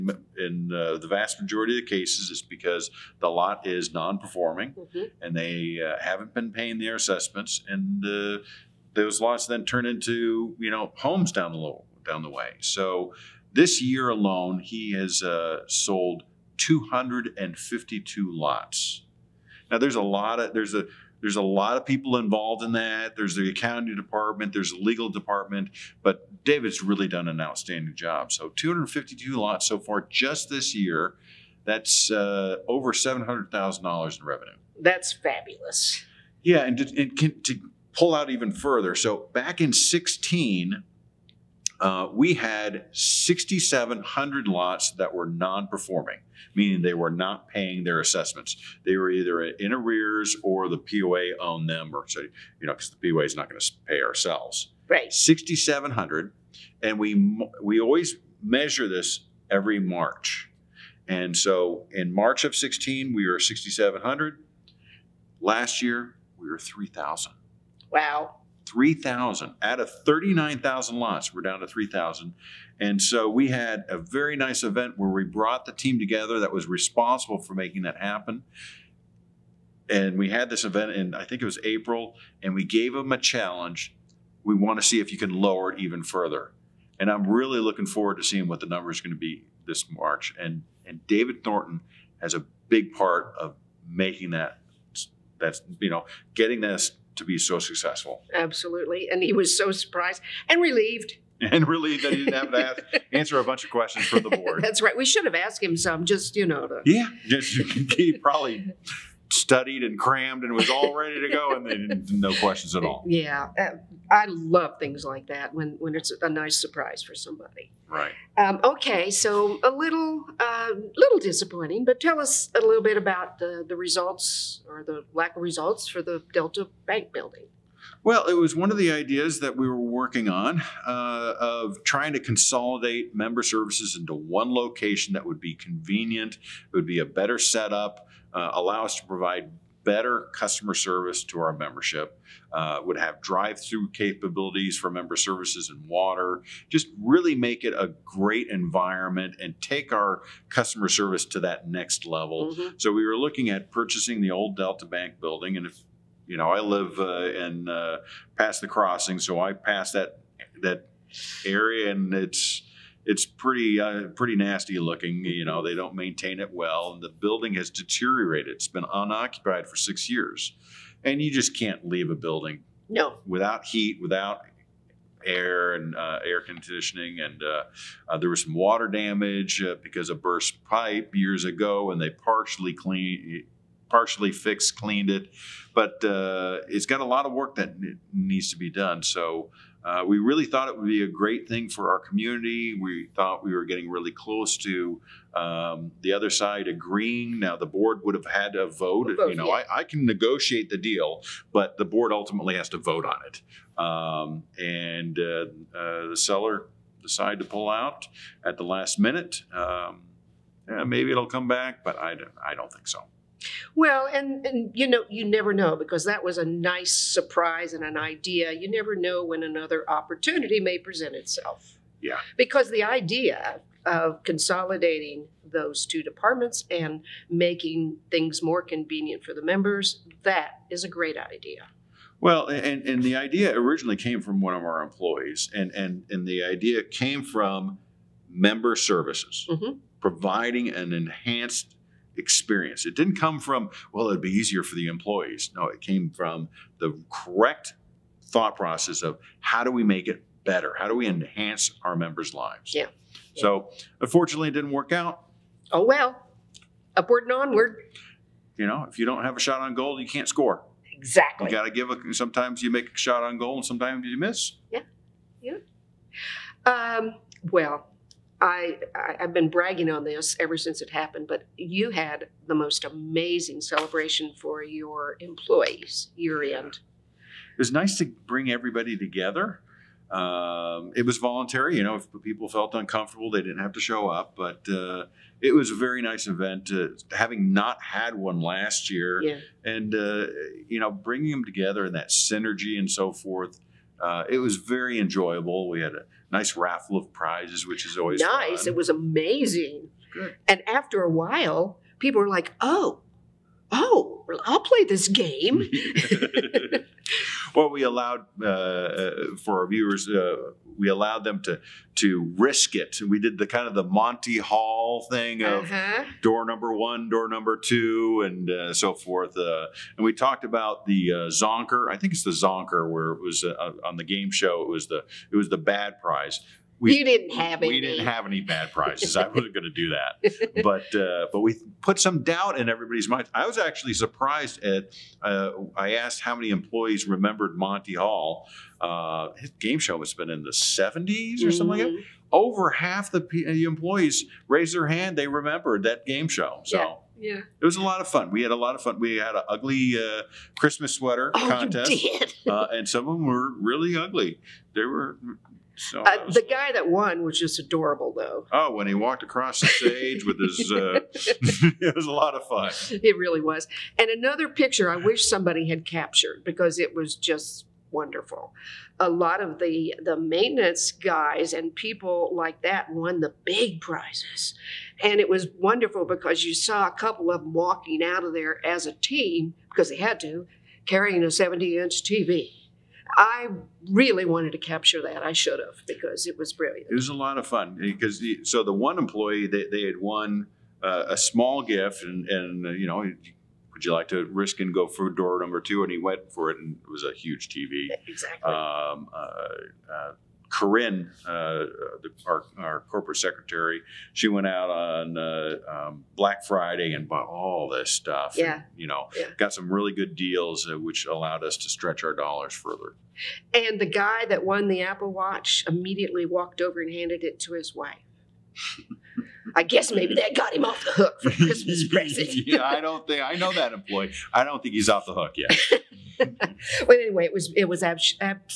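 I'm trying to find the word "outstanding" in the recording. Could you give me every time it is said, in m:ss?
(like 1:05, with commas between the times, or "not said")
0:27.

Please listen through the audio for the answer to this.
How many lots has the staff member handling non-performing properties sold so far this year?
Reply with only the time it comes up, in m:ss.
0:14.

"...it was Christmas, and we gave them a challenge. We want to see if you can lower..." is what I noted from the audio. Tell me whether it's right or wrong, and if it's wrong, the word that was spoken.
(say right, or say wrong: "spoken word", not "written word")
wrong: "April", not "Christmas".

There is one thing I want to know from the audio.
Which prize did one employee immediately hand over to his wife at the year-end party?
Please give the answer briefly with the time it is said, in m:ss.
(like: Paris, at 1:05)
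Apple Watch, at 6:53.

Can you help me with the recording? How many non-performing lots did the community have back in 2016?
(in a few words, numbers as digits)
6,700.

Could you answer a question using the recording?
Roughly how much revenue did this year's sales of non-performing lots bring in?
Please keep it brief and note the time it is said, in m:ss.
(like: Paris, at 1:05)
Over $700,000, at 0:32.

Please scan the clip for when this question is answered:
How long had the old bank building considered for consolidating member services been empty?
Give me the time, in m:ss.
2:48.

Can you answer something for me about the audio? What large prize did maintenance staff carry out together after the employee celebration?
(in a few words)
70 inch TV.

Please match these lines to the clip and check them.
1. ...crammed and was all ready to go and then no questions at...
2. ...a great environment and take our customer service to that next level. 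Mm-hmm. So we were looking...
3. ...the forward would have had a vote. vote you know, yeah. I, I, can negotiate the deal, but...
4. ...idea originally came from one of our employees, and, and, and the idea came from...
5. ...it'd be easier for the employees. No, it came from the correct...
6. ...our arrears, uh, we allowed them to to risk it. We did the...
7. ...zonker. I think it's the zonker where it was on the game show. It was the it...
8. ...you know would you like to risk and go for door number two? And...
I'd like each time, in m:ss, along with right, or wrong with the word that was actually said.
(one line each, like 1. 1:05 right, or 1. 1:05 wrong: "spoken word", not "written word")
1. 1:49 right
2. 2:27 right
3. 3:17 wrong: "board", not "forward"
4. 3:53 right
5. 4:04 right
6. 5:09 wrong: "viewers", not "arrears"
7. 5:21 right
8. 6:32 right.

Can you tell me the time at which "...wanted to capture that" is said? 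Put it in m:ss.
6:24.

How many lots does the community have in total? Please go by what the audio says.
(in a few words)
39,000.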